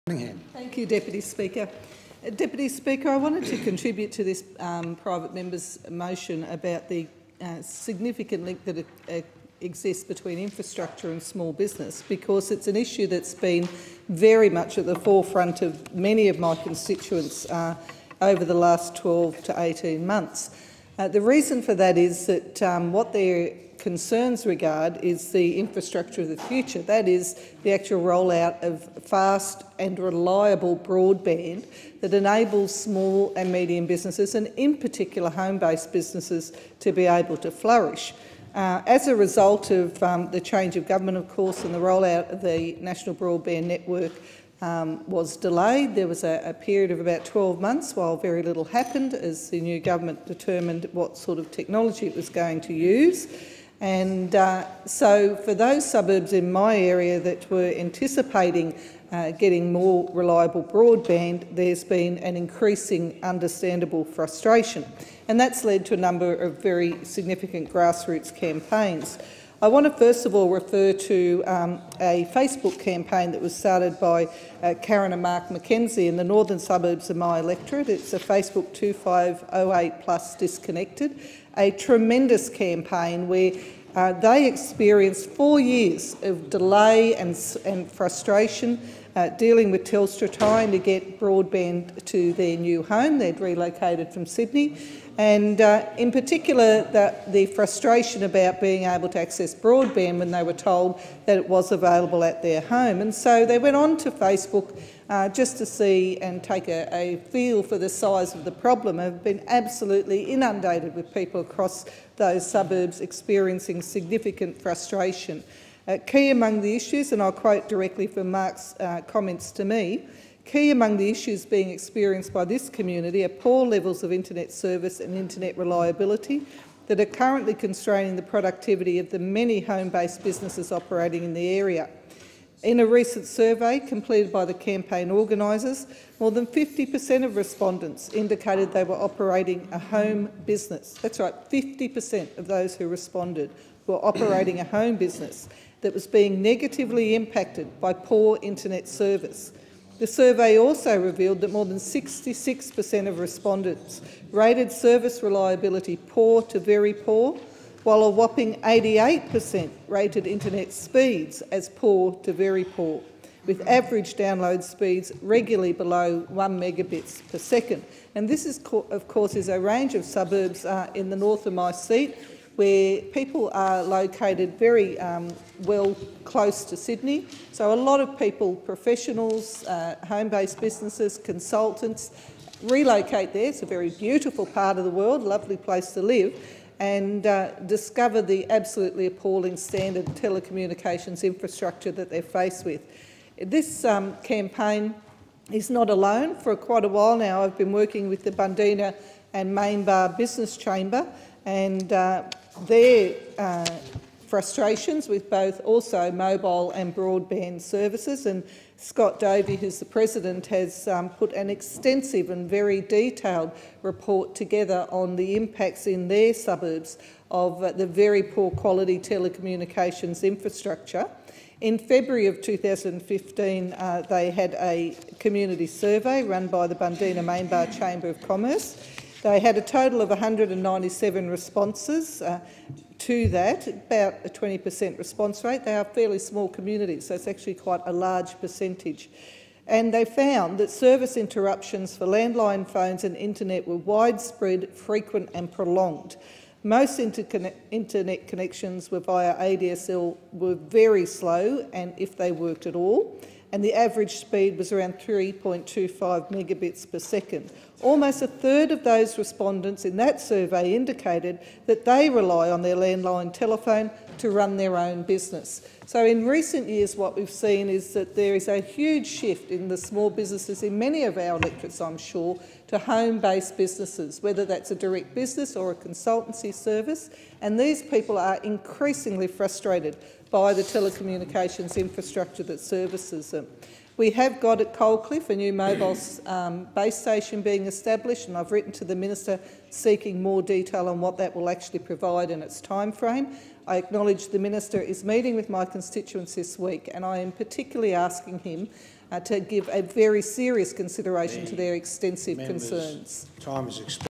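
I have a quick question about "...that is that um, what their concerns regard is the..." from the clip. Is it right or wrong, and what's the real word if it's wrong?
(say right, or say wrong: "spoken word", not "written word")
right.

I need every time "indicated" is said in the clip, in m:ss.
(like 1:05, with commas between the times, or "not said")
2:18, 4:20.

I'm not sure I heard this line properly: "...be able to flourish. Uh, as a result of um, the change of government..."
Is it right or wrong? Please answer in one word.
right.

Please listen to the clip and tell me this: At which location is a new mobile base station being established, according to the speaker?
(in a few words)
Coalcliff.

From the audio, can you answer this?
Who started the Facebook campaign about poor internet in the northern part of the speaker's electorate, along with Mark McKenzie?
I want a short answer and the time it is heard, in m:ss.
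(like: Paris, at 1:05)
Karen, at 1:14.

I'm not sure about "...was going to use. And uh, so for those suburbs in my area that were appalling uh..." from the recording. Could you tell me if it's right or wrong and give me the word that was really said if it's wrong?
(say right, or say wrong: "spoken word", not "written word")
wrong: "anticipating", not "appalling".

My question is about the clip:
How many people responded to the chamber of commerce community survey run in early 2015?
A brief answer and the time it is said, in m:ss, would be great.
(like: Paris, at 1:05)
197, at 3:50.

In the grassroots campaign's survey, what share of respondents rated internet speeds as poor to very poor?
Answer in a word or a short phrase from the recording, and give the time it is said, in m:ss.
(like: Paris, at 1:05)
88%, at 2:38.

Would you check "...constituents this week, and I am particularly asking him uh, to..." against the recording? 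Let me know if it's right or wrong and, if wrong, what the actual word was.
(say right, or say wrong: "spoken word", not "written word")
right.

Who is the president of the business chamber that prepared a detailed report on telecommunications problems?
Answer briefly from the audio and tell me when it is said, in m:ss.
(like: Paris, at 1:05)
Scott Davey, at 3:28.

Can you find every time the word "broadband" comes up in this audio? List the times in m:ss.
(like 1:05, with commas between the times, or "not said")
0:30, 0:43, 1:00, 1:31, 1:39, 3:26.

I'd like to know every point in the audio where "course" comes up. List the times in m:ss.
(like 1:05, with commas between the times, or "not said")
0:41, 2:49.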